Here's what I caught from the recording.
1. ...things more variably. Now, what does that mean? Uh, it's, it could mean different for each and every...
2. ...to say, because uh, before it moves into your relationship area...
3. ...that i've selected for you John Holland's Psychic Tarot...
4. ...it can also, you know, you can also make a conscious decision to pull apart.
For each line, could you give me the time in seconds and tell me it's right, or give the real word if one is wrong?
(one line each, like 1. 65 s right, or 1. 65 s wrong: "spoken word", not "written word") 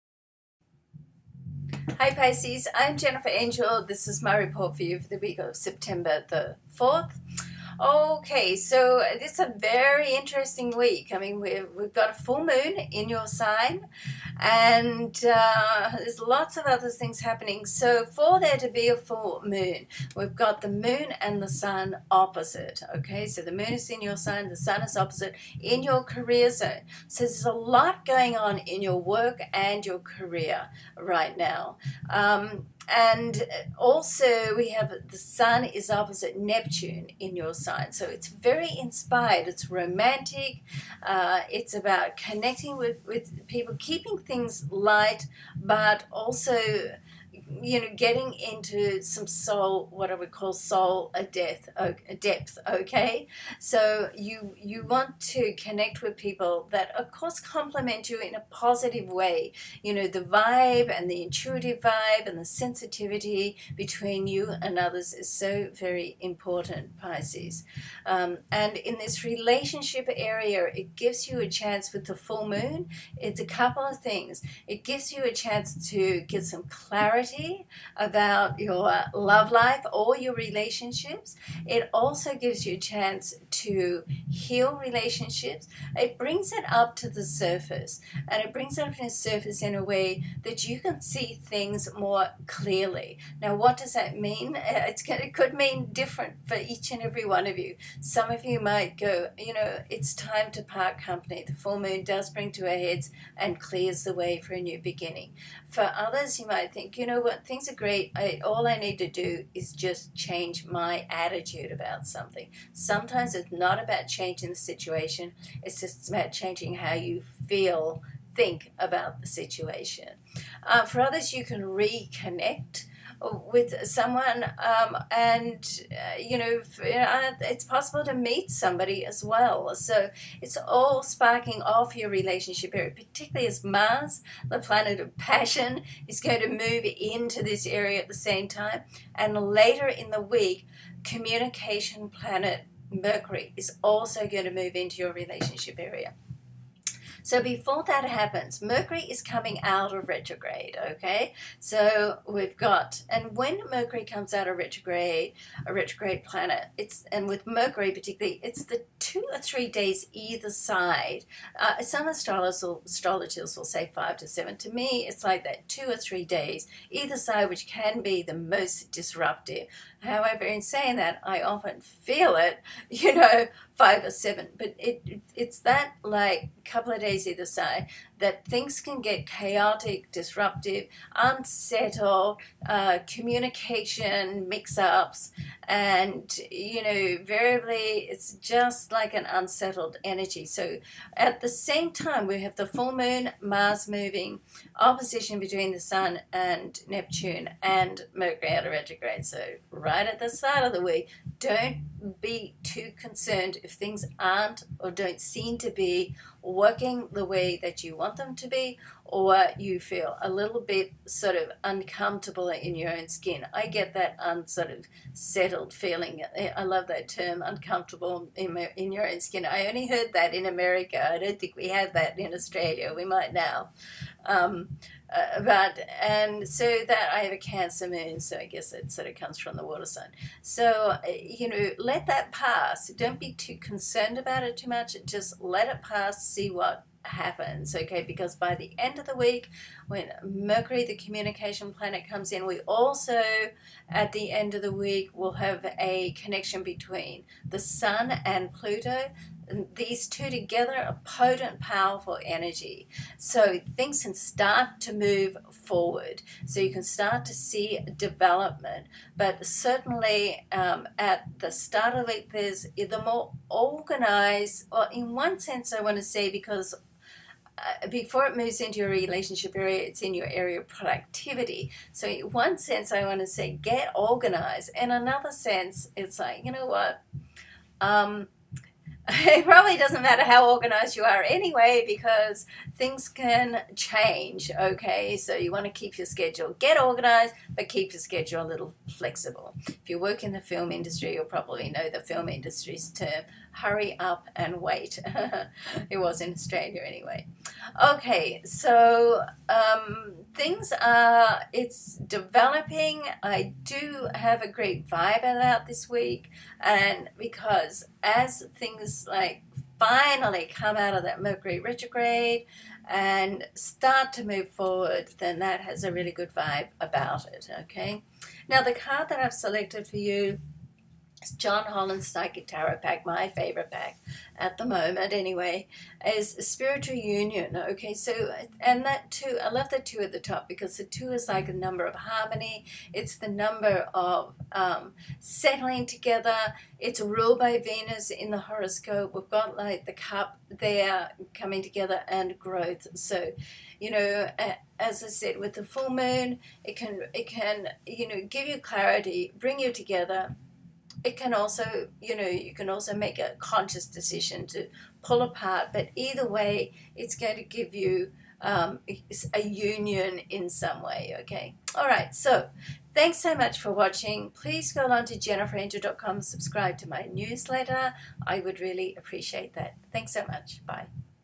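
1. 91 s wrong: "clearly", not "variably"
2. 265 s right
3. 319 s right
4. 351 s right.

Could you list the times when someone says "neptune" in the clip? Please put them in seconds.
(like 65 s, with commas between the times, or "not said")
36 s, 196 s.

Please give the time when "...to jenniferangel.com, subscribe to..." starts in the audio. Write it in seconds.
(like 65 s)
365 s.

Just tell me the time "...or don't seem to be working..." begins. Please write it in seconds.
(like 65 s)
204 s.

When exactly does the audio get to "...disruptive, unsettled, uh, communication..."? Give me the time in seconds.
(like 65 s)
180 s.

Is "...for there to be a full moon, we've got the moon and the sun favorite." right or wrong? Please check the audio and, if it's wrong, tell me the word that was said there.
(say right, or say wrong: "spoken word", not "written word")
wrong: "opposite", not "favorite".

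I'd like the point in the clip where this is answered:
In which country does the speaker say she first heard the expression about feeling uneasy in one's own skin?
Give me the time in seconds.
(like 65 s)
220 s.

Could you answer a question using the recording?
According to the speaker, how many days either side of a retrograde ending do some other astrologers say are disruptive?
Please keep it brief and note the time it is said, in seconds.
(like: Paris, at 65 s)
5 to 7, at 163 s.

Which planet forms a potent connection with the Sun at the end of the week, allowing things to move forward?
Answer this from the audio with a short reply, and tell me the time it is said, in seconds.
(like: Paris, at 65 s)
Pluto, at 248 s.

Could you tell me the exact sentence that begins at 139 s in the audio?
And later in the week, communication planet Mercury is also going to move into your relationship area.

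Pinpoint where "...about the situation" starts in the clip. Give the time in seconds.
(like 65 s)
118 s.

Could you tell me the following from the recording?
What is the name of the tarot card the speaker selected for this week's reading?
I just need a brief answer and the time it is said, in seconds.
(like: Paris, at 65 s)
Spiritual Union, at 326 s.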